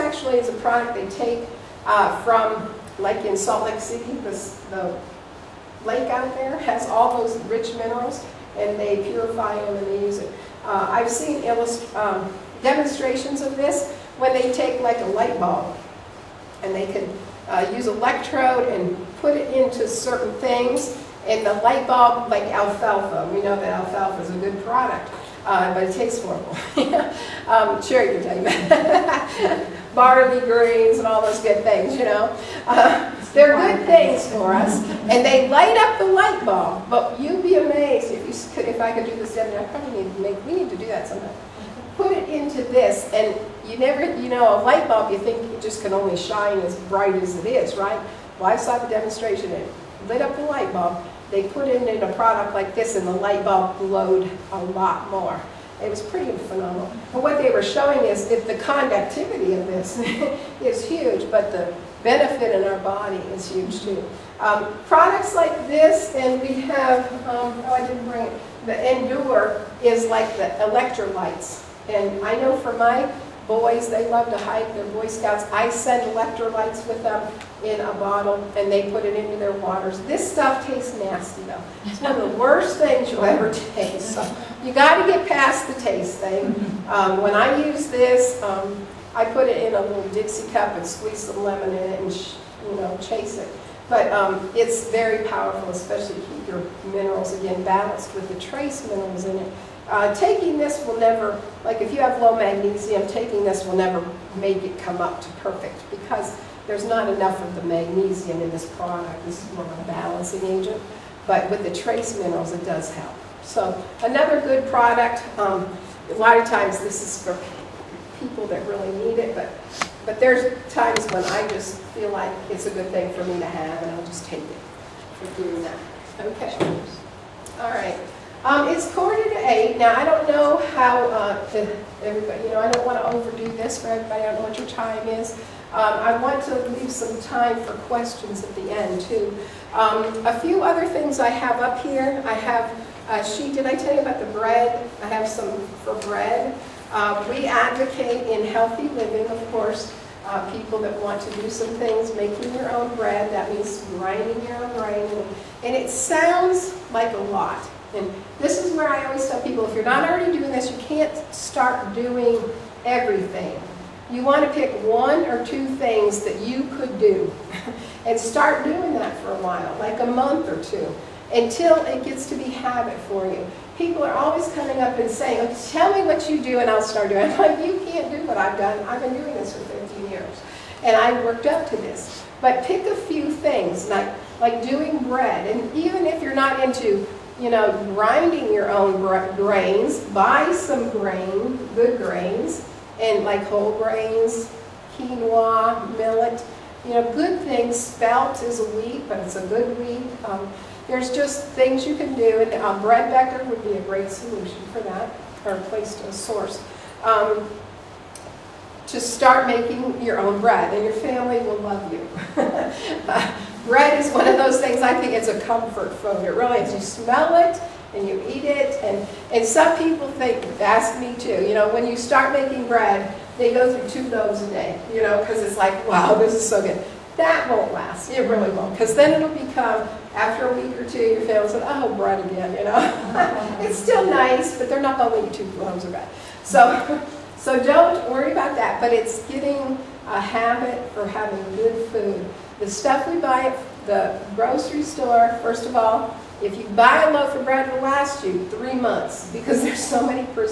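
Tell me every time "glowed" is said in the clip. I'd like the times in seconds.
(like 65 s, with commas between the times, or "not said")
53 s.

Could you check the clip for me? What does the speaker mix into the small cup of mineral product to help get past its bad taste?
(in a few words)
lemon.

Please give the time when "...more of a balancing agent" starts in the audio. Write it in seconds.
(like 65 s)
109 s.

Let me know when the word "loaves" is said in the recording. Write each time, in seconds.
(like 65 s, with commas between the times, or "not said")
224 s, 235 s.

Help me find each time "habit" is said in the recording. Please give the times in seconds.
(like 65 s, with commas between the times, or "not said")
172 s, 240 s.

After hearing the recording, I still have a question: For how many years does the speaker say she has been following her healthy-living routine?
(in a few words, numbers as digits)
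15.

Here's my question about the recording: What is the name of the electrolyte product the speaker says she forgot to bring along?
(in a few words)
Endure.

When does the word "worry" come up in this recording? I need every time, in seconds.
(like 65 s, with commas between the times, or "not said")
238 s.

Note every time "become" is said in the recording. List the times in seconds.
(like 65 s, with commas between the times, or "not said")
229 s.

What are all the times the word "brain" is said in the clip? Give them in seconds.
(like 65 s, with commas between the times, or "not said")
not said.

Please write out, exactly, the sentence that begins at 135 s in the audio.
Um, I want to leave some time for questions at the end, too.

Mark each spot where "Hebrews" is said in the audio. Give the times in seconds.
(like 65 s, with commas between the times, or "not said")
not said.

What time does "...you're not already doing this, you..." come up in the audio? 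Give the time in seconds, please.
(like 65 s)
159 s.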